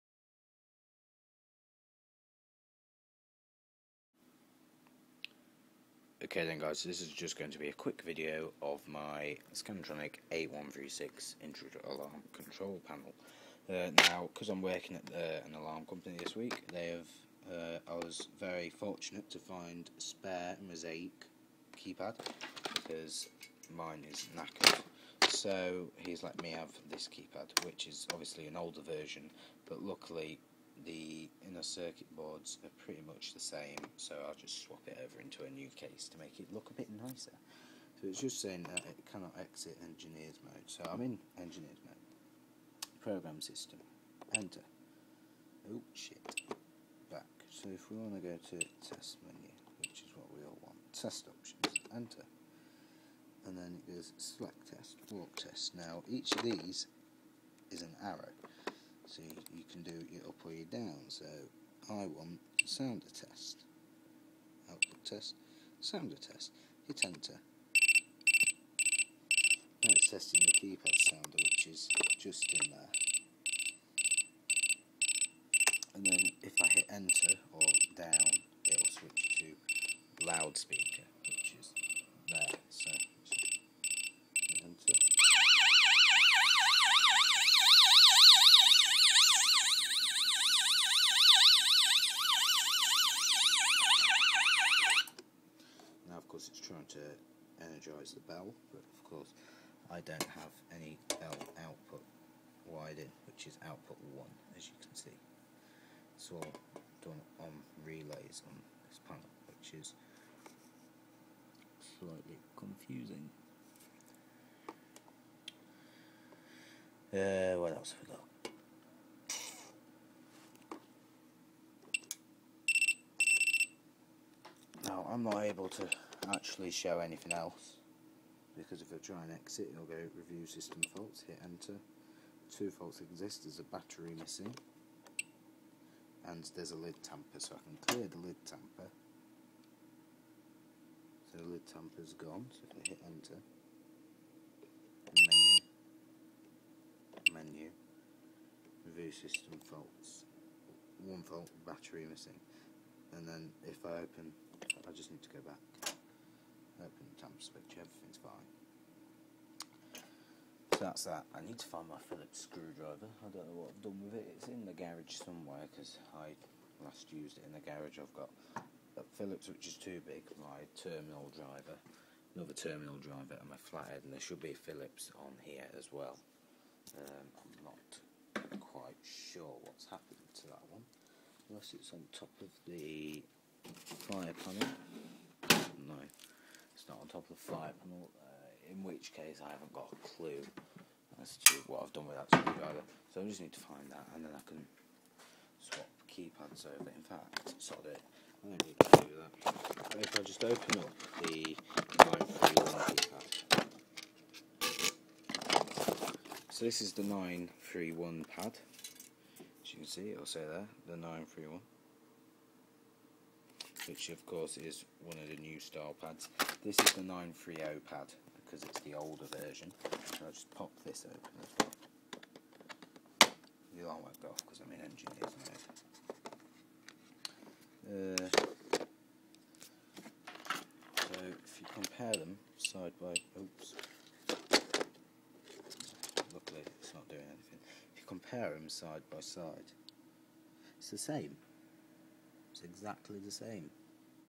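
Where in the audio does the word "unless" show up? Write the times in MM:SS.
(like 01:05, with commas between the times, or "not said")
03:01.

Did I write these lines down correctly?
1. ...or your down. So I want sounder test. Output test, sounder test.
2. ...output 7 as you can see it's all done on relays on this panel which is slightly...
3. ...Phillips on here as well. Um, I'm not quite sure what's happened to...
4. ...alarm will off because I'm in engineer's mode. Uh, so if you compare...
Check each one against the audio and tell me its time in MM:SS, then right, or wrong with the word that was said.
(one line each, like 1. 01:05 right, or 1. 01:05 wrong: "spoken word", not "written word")
1. 01:00 right
2. 01:43 wrong: "1", not "7"
3. 02:54 right
4. 03:43 right.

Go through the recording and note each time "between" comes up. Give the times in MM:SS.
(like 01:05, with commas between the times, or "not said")
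not said.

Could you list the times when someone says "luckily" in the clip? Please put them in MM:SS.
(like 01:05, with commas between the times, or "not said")
00:29, 03:56.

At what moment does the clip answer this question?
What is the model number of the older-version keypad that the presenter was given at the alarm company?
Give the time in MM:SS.
03:37.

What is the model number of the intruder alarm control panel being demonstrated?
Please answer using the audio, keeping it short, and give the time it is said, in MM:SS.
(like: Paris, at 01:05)
8136, at 00:10.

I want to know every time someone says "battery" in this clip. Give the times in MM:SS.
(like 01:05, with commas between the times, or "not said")
02:13, 02:31.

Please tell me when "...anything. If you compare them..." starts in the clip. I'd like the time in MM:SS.
03:57.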